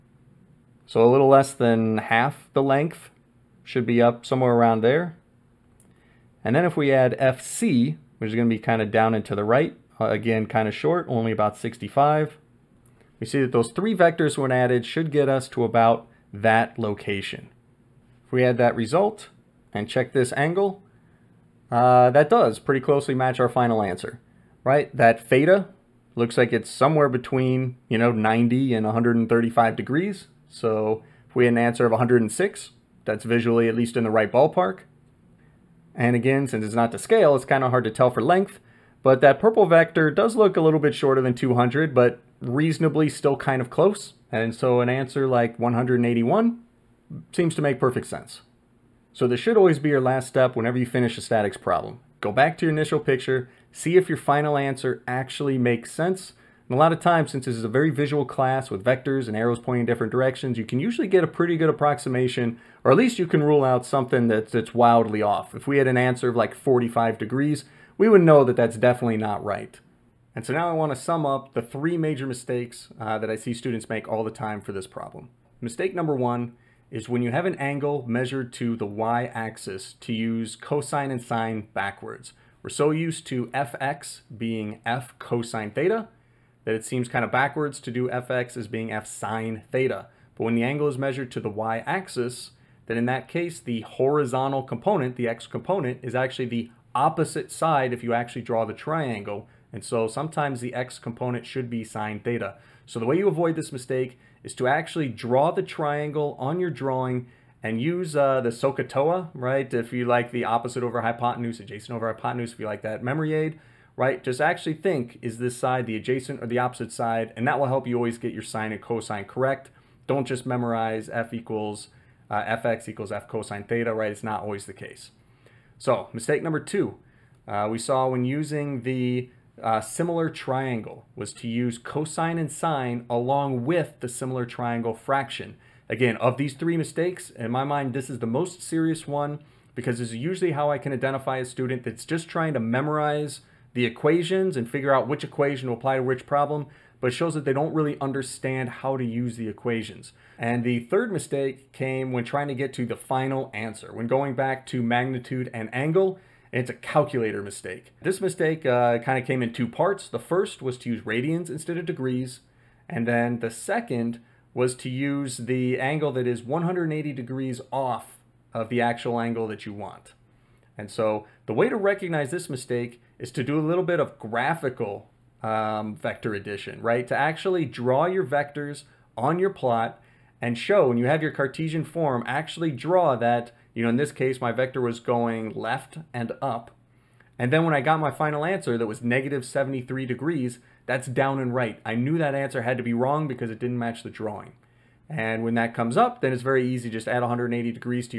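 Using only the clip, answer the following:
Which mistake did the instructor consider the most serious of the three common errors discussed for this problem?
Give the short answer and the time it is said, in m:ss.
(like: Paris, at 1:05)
Mistake number two, at 2:06.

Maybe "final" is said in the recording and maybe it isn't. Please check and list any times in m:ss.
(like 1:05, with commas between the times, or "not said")
0:23, 0:54, 2:32, 3:08.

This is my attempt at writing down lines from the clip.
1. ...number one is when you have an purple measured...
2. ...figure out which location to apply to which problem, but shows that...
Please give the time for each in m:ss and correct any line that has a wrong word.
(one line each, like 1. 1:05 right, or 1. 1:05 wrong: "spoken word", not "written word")
1. 1:15 wrong: "angle", not "purple"
2. 2:24 wrong: "equation", not "location".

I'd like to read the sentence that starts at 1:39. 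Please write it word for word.
And so sometimes the x component should be sine theta.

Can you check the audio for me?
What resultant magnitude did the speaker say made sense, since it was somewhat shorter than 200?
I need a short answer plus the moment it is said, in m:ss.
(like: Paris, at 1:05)
181, at 0:45.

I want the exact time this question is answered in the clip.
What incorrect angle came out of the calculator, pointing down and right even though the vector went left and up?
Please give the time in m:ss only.
3:09.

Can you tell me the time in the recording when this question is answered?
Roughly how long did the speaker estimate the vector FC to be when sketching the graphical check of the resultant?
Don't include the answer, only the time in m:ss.
0:11.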